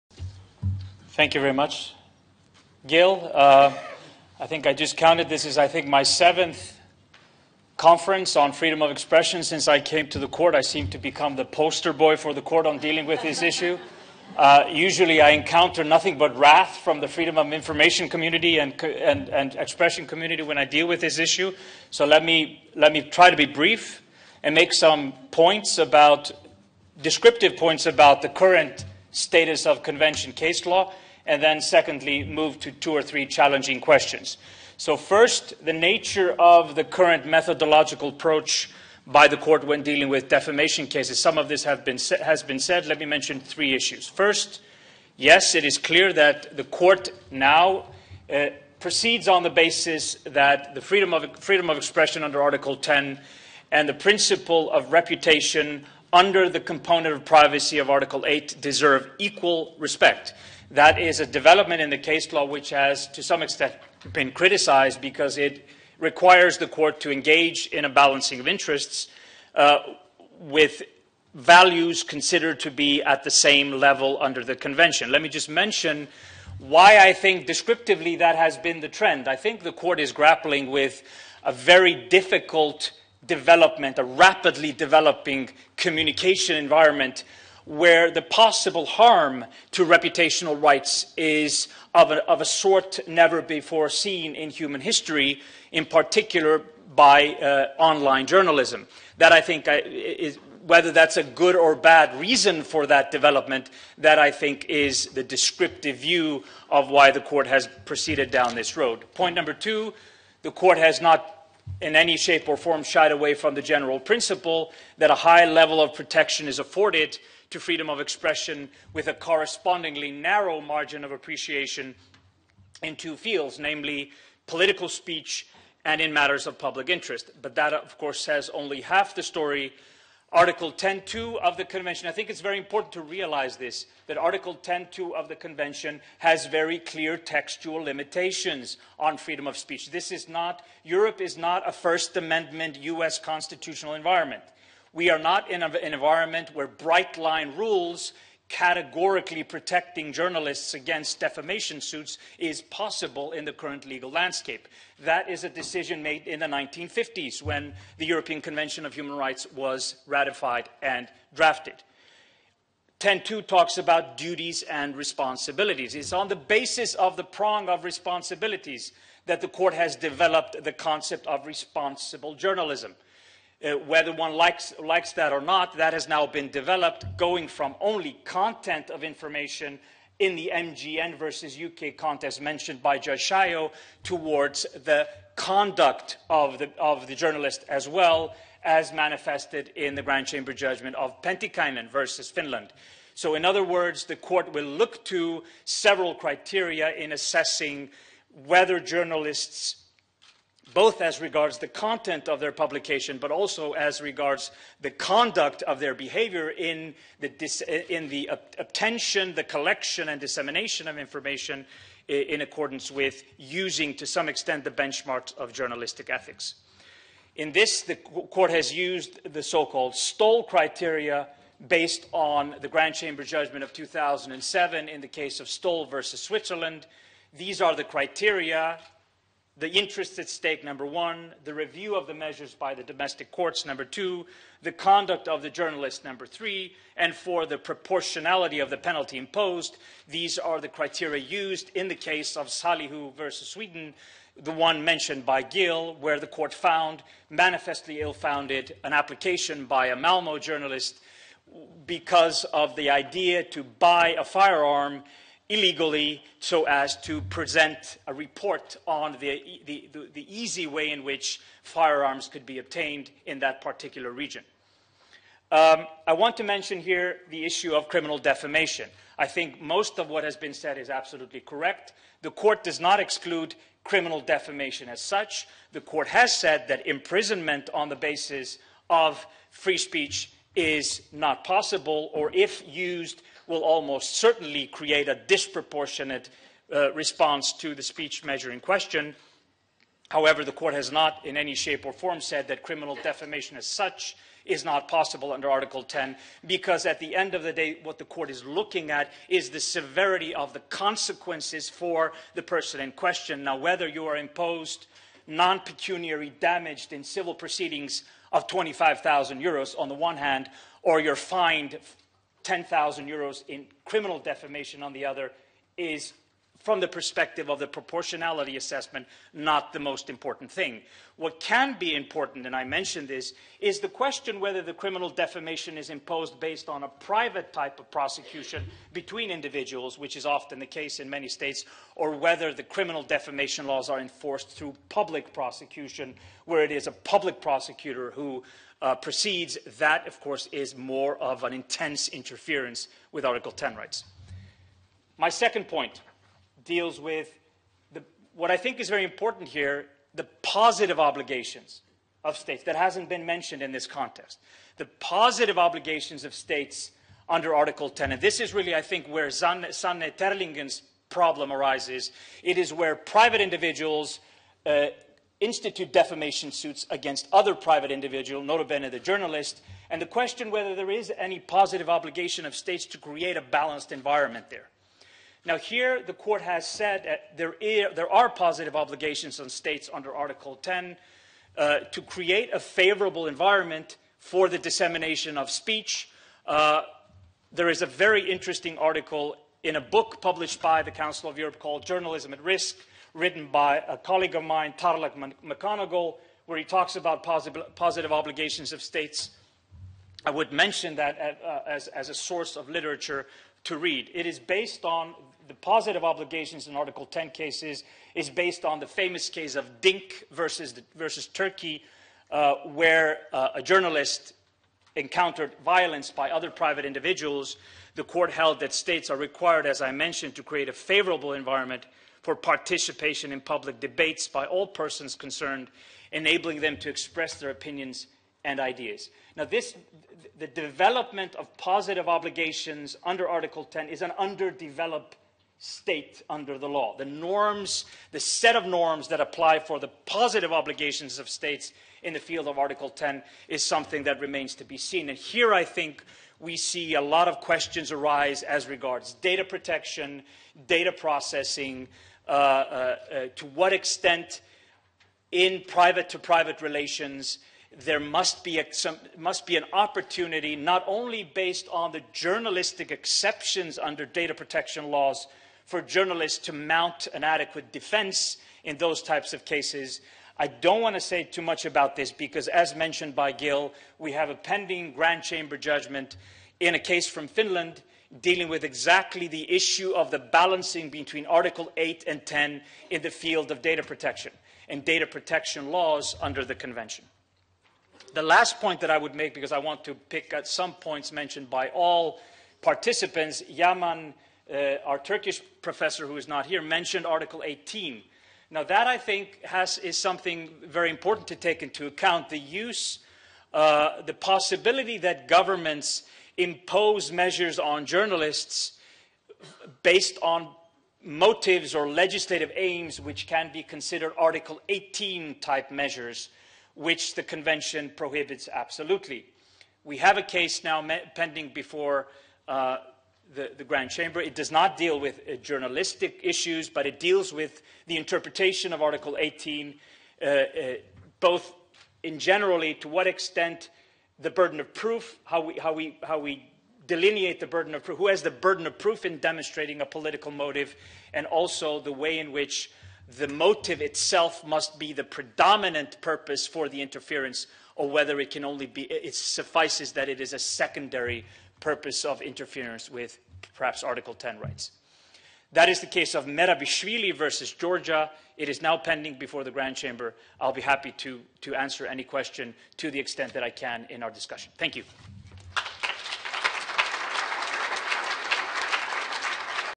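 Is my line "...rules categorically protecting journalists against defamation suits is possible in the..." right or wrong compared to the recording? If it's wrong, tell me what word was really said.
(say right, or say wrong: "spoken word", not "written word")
right.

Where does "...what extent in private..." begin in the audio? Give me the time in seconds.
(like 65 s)
453 s.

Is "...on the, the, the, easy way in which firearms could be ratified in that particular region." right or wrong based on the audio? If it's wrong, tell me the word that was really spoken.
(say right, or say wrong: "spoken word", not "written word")
wrong: "obtained", not "ratified".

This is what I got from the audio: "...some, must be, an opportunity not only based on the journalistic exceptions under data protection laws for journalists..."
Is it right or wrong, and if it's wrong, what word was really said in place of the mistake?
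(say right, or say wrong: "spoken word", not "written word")
right.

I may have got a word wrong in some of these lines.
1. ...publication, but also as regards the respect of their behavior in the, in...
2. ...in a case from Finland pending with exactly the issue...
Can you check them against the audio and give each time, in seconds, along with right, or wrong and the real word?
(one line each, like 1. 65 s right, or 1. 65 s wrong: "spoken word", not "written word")
1. 202 s wrong: "conduct", not "respect"
2. 476 s wrong: "dealing", not "pending".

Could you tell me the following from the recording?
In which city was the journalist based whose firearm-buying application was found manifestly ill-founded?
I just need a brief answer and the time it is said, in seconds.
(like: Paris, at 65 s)
Malmo, at 249 s.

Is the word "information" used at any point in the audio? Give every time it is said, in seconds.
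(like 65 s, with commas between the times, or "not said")
17 s, 179 s, 210 s.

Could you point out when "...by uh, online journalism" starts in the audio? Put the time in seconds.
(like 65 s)
96 s.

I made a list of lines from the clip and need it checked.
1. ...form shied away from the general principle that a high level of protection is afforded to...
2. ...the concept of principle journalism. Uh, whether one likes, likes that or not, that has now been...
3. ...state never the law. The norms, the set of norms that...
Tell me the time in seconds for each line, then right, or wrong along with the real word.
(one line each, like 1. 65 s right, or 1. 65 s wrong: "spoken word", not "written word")
1. 112 s right
2. 170 s wrong: "responsible", not "principle"
3. 435 s wrong: "under", not "never".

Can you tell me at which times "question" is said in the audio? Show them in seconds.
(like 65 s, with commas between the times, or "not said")
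33 s, 288 s, 302 s, 323 s, 370 s, 447 s, 562 s.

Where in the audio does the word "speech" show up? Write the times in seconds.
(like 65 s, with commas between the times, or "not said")
124 s, 139 s, 279 s, 287 s, 385 s.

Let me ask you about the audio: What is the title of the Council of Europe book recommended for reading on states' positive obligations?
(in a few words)
Journalism at Risk.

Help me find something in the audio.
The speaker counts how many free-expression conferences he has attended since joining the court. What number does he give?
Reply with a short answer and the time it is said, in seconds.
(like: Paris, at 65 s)
7th, at 6 s.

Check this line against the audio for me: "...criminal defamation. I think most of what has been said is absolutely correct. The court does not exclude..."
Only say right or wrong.
right.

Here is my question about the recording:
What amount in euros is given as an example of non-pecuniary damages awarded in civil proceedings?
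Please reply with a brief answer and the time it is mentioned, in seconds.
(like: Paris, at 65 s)
25,000 euros, at 308 s.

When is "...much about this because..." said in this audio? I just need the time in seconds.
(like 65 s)
471 s.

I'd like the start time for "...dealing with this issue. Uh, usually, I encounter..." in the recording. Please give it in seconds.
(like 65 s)
12 s.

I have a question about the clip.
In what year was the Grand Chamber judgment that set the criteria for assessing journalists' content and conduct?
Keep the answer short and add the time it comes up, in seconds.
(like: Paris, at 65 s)
2007, at 223 s.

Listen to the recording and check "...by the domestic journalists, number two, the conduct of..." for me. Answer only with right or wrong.
wrong.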